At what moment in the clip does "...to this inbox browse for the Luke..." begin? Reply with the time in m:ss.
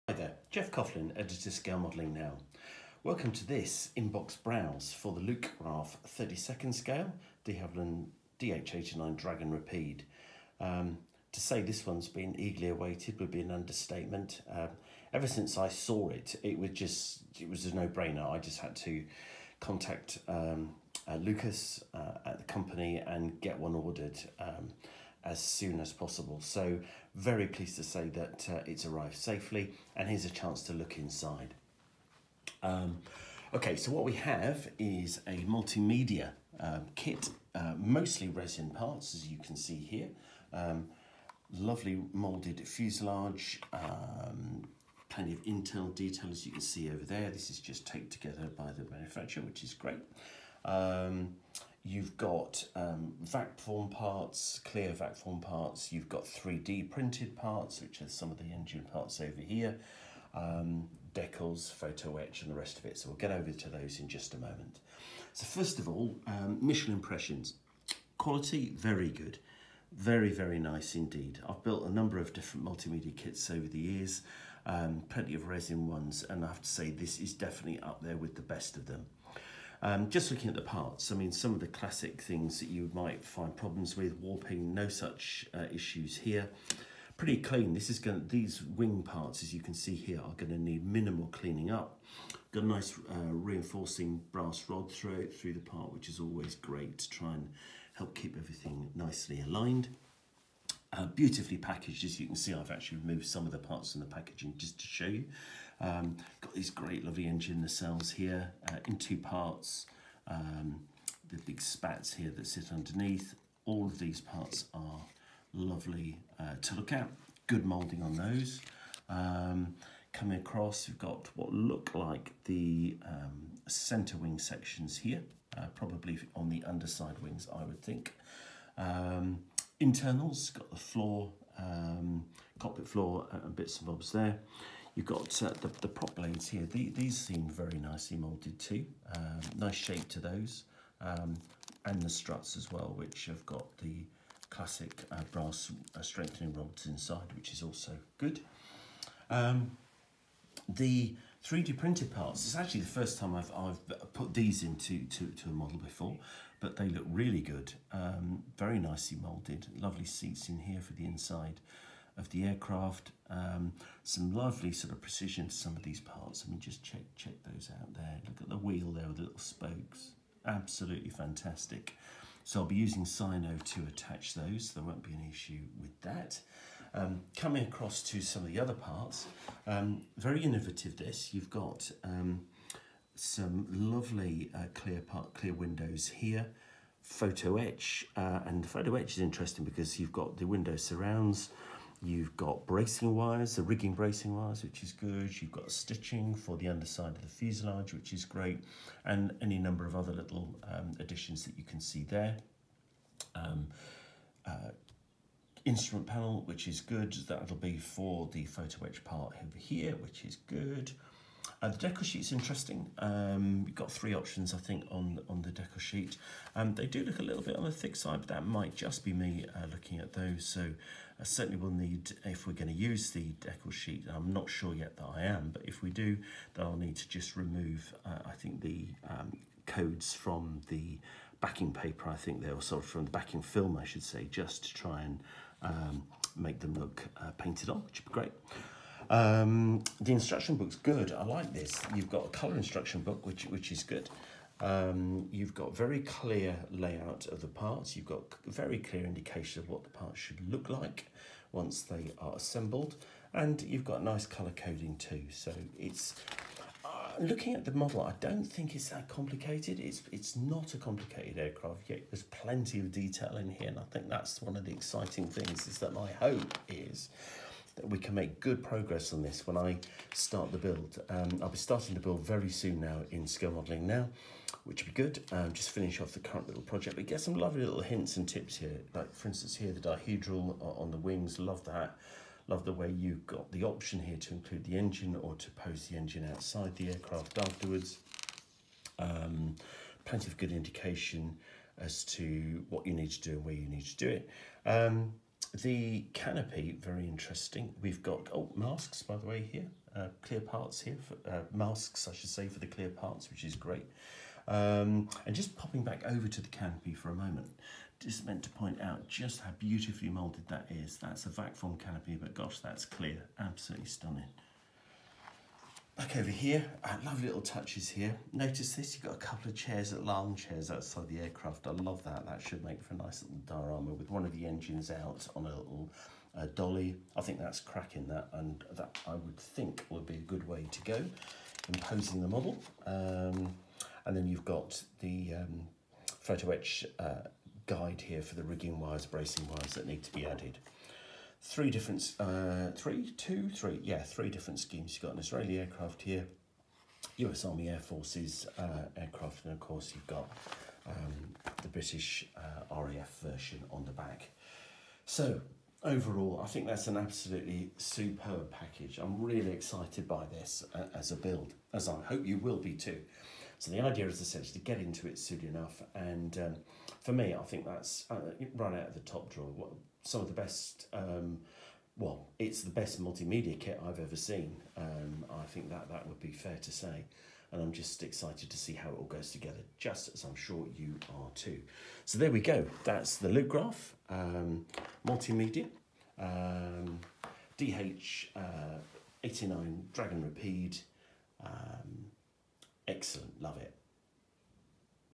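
0:03.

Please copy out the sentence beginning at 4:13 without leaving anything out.
And you've got nice colour coding too.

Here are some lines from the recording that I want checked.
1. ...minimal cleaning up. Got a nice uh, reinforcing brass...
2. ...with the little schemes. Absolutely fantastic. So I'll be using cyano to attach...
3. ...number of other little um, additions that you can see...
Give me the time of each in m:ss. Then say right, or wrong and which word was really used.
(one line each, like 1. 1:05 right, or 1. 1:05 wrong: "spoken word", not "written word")
1. 1:30 right
2. 2:49 wrong: "spokes", not "schemes"
3. 3:19 right.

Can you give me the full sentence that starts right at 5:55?
So overall, I think that's an absolutely superb package.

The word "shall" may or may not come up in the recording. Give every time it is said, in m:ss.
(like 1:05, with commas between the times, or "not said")
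not said.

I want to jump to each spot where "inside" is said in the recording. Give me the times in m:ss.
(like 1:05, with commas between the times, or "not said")
0:30, 2:26, 2:41.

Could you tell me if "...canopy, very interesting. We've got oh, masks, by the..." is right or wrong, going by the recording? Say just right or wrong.
right.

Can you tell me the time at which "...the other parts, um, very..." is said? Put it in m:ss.
2:58.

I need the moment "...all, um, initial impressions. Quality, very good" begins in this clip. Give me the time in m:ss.
1:05.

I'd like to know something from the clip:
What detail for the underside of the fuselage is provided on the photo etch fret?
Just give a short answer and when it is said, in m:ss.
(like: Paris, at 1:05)
Stitching, at 3:15.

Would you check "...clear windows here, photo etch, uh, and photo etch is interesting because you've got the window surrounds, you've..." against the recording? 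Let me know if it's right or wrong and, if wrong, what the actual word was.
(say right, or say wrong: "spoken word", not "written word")
right.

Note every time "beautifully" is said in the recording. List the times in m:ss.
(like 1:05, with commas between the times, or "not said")
1:41, 5:09.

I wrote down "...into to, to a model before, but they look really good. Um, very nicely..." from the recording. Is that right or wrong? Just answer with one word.
right.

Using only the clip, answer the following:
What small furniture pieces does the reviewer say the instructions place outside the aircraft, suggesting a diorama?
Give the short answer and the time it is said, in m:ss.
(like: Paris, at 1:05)
Armchairs, at 5:19.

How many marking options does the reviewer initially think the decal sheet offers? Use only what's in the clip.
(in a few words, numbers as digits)
3.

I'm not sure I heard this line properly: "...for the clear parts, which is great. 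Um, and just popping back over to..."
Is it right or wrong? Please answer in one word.
right.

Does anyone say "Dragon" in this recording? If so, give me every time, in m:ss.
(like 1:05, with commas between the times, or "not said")
0:09, 6:29.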